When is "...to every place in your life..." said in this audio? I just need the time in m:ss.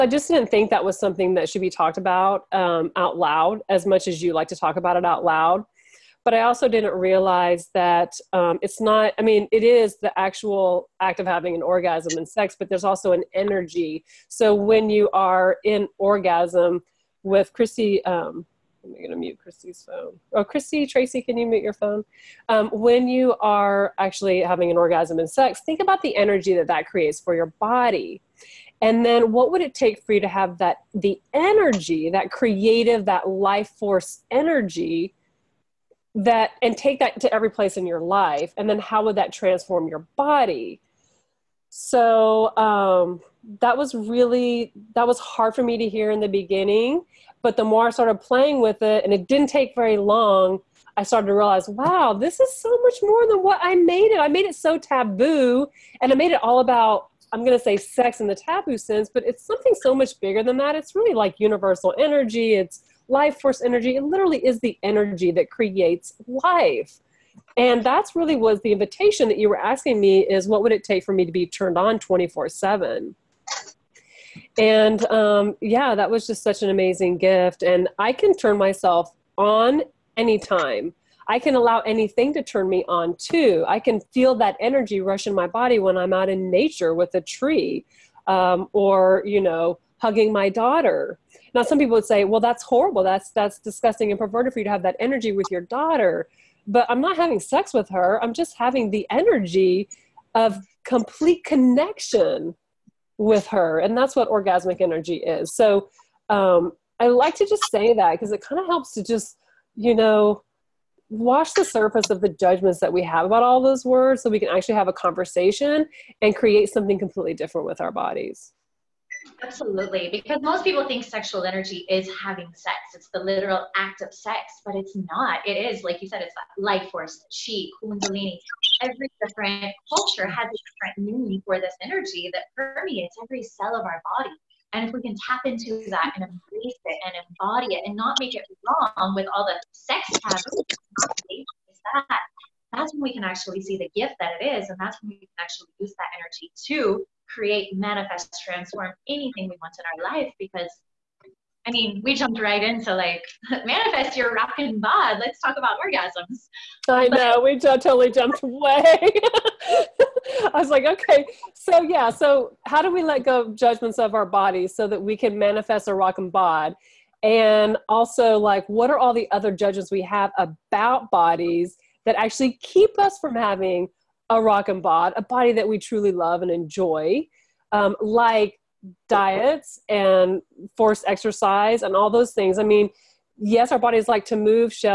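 0:37.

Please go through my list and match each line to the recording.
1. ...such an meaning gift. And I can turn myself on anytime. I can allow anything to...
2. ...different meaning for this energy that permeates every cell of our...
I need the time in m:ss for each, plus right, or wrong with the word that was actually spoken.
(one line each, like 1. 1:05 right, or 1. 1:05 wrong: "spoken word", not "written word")
1. 1:16 wrong: "amazing", not "meaning"
2. 2:10 right.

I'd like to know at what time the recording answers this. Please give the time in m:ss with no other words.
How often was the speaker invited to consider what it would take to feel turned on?
1:11.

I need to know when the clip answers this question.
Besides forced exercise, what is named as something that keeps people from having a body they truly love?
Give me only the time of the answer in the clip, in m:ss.
2:59.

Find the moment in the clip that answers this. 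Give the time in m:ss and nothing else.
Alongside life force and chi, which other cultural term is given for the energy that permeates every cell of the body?
2:07.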